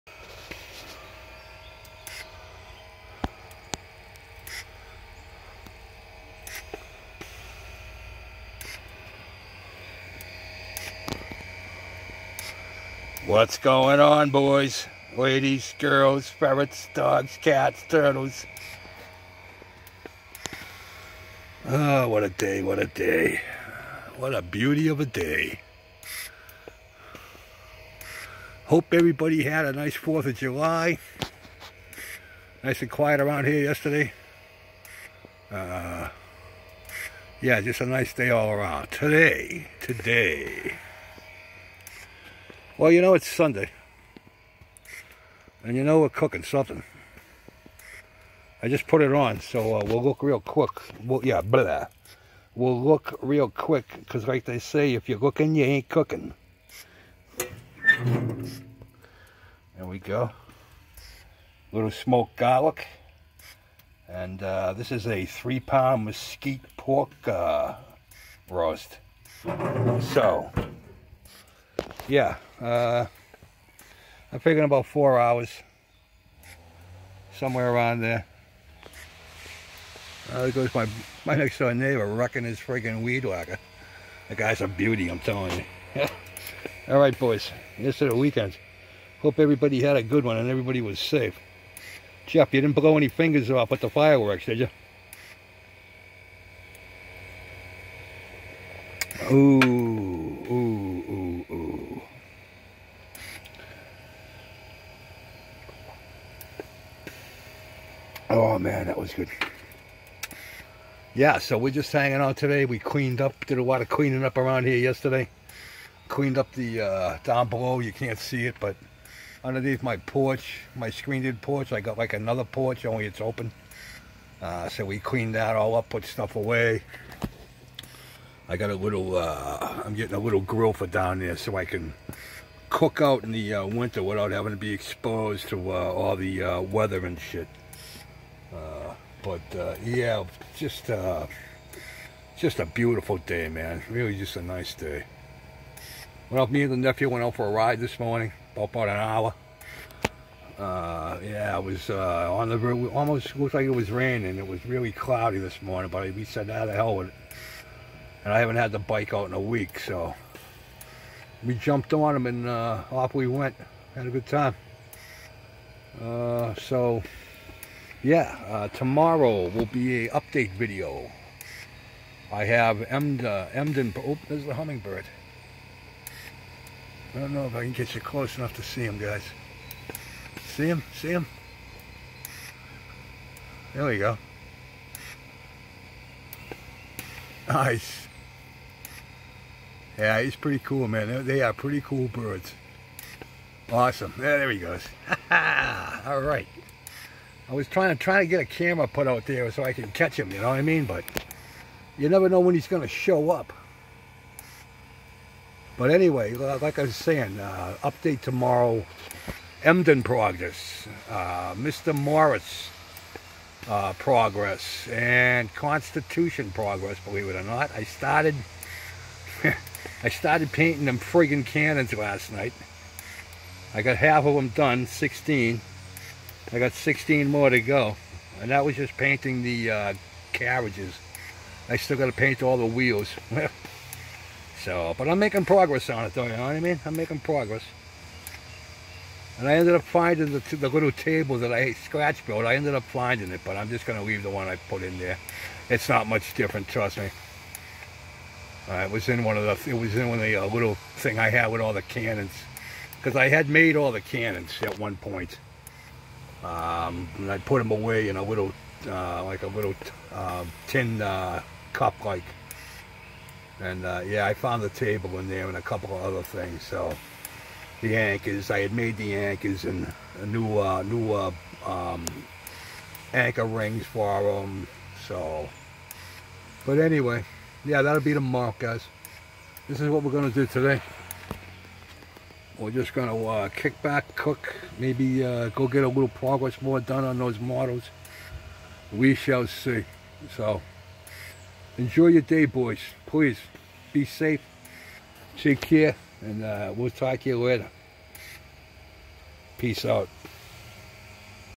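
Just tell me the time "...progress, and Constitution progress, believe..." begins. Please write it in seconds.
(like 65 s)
213 s.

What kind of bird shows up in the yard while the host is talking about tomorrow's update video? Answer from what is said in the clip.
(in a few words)
hummingbird.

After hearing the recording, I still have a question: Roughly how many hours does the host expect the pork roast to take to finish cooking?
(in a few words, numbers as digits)
4 hours.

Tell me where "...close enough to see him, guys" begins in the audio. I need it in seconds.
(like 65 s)
178 s.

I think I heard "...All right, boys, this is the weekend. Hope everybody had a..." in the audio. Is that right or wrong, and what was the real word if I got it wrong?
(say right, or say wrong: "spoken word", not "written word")
right.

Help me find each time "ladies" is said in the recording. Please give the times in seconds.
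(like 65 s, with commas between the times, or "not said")
15 s.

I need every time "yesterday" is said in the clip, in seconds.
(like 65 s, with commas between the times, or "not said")
33 s, 114 s.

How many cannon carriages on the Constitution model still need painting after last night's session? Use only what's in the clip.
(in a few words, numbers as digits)
16.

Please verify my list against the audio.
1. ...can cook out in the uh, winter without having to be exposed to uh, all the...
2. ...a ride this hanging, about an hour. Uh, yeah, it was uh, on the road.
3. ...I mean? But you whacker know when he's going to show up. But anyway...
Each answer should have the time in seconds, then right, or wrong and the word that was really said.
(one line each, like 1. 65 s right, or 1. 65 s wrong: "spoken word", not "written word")
1. 131 s right
2. 147 s wrong: "morning", not "hanging"
3. 200 s wrong: "never", not "whacker".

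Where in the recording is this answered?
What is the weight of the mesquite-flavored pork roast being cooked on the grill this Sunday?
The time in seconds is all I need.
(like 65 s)
65 s.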